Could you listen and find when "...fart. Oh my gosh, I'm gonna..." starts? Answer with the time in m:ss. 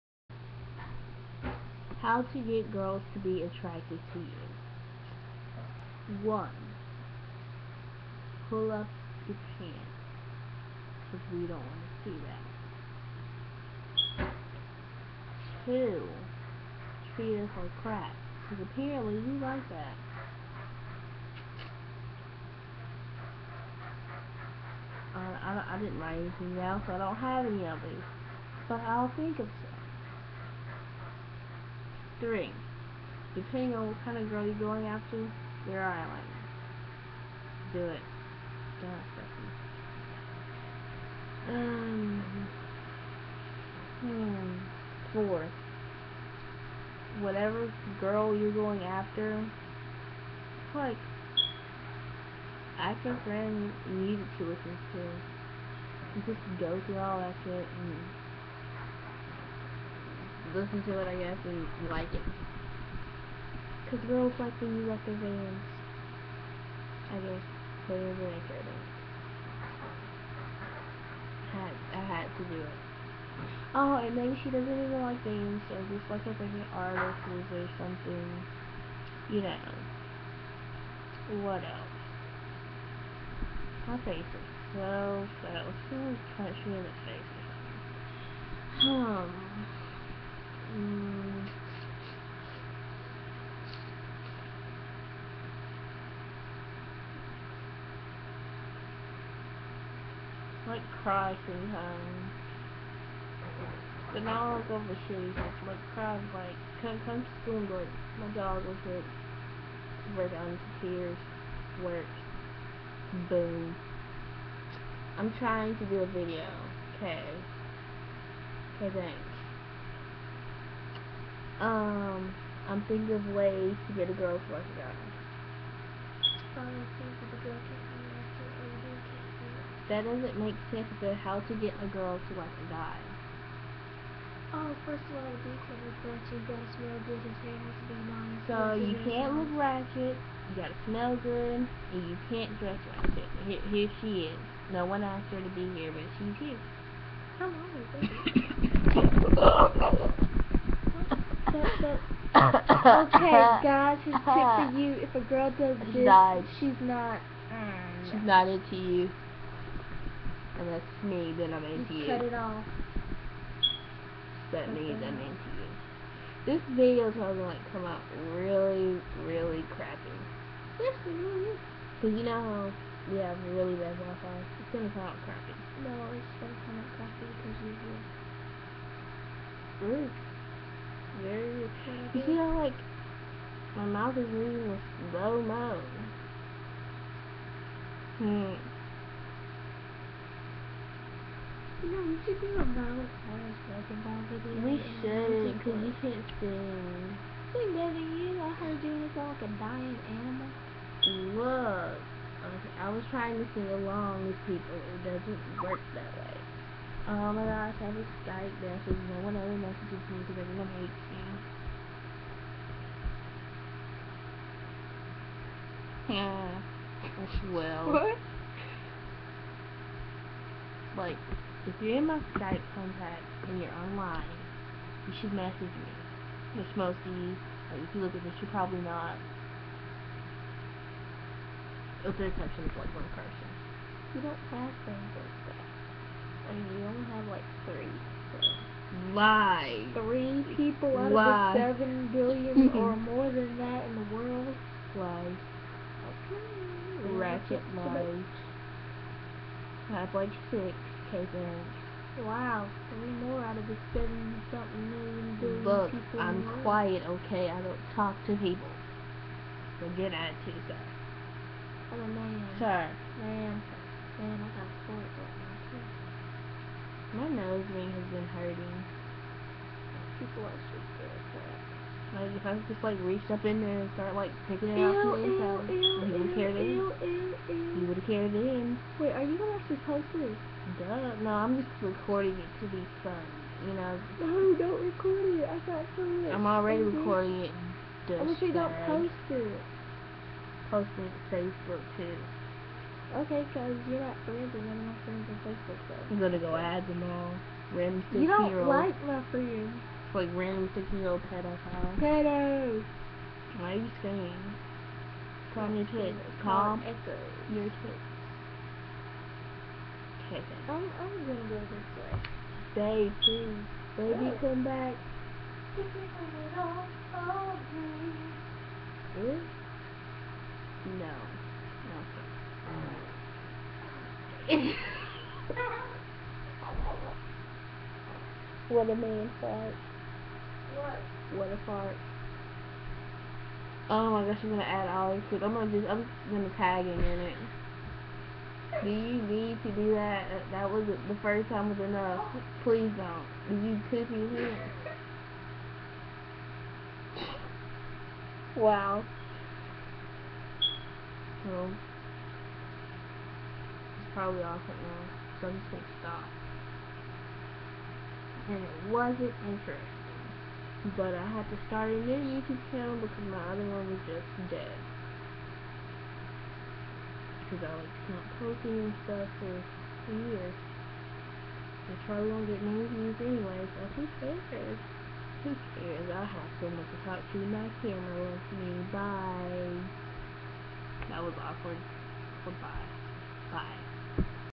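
5:31.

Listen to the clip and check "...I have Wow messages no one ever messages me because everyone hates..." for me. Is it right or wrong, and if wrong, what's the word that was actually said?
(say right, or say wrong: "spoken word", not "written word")
wrong: "Skype", not "Wow".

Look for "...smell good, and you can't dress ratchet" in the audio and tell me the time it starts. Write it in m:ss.
2:20.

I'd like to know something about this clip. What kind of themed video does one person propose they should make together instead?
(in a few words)
Valentine's basketball video.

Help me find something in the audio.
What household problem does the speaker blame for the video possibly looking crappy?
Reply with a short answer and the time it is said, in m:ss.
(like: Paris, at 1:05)
Wi-Fi, at 2:53.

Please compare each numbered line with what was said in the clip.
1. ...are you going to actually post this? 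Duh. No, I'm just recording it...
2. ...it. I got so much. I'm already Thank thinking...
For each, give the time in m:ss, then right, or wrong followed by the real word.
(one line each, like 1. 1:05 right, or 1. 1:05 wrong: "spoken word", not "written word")
1. 4:39 right
2. 4:45 wrong: "recording", not "thinking".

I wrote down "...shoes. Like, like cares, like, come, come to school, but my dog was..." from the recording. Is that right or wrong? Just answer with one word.
wrong.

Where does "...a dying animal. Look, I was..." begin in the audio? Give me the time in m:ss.
3:19.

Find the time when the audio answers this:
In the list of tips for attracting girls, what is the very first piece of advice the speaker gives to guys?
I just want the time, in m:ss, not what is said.
0:08.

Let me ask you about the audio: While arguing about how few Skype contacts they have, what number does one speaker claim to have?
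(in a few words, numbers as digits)
6.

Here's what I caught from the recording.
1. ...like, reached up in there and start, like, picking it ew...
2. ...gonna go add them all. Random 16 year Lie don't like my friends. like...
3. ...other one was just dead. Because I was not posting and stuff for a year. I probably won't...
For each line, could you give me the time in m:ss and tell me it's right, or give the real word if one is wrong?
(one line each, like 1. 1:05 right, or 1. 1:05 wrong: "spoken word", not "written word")
1. 4:32 right
2. 4:56 wrong: "You", not "Lie"
3. 6:03 right.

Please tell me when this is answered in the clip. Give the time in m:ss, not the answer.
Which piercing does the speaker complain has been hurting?
4:27.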